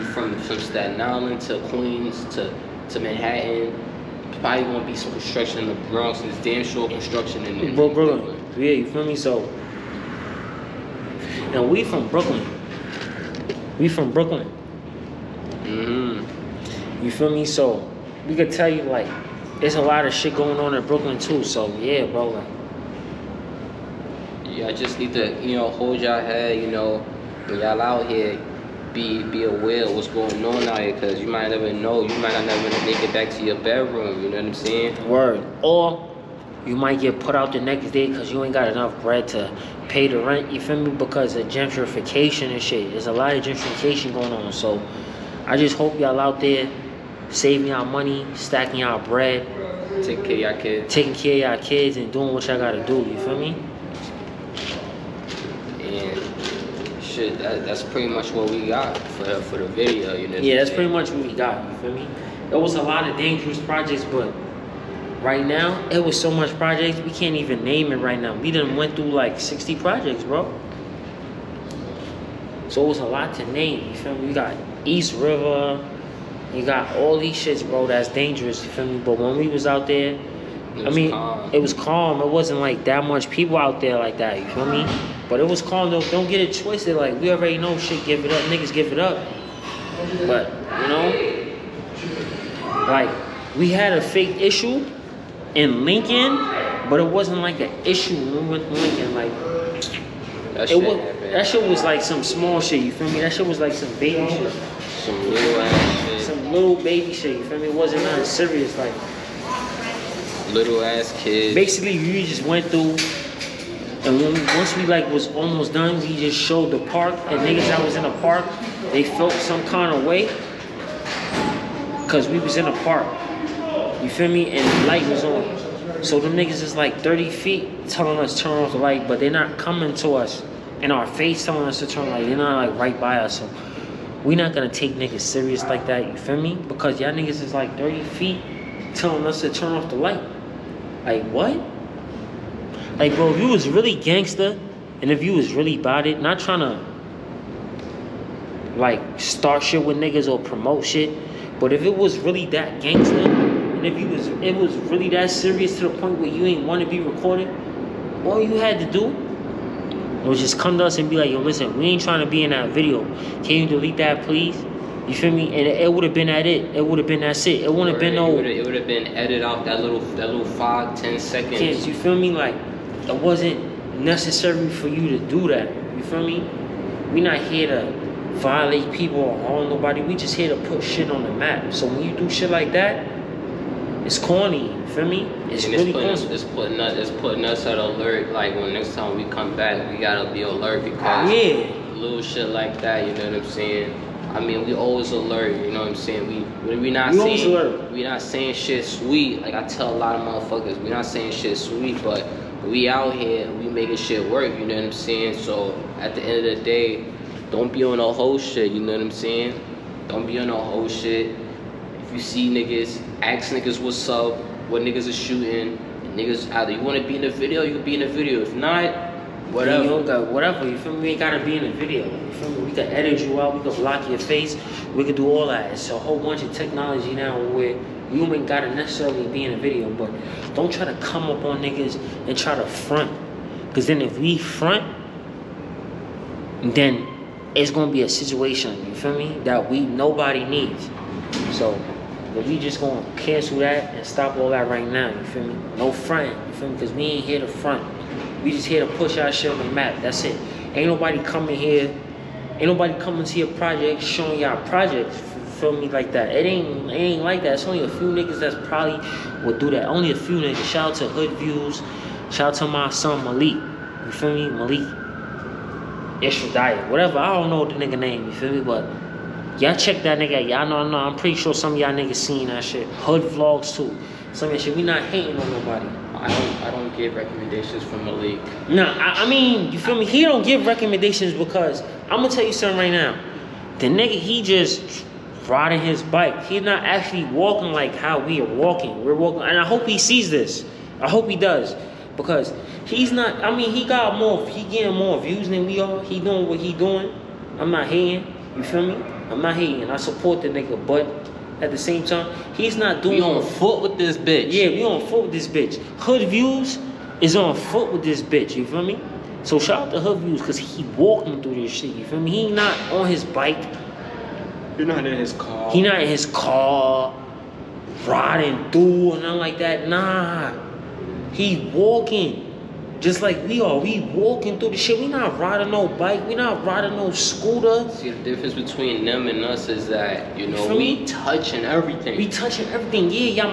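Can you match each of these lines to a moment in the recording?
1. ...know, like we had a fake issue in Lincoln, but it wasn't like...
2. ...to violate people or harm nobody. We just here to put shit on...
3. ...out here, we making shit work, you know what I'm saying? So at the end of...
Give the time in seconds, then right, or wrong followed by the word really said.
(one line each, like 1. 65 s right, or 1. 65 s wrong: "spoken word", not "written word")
1. 90 s right
2. 177 s right
3. 202 s right.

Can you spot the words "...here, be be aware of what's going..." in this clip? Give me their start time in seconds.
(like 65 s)
28 s.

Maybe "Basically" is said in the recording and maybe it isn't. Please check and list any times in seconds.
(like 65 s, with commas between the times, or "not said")
111 s.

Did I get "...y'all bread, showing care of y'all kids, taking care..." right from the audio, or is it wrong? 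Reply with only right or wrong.
wrong.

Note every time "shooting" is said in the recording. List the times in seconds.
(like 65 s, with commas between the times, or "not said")
215 s.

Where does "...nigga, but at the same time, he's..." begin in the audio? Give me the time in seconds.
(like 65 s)
300 s.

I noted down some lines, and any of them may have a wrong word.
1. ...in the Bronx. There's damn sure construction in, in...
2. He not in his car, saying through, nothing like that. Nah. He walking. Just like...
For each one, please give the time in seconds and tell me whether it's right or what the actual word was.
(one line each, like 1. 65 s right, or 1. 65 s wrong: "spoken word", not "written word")
1. 5 s right
2. 315 s wrong: "riding", not "saying".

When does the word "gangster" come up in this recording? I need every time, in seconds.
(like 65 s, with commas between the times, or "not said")
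143 s, 152 s.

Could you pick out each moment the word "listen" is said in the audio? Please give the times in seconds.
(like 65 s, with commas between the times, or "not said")
161 s.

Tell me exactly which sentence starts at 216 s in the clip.
Niggas either you wanna be in the video, you can be in the video.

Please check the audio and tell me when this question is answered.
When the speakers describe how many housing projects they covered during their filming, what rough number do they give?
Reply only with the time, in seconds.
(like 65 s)
69 s.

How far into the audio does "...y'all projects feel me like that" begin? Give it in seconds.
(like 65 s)
254 s.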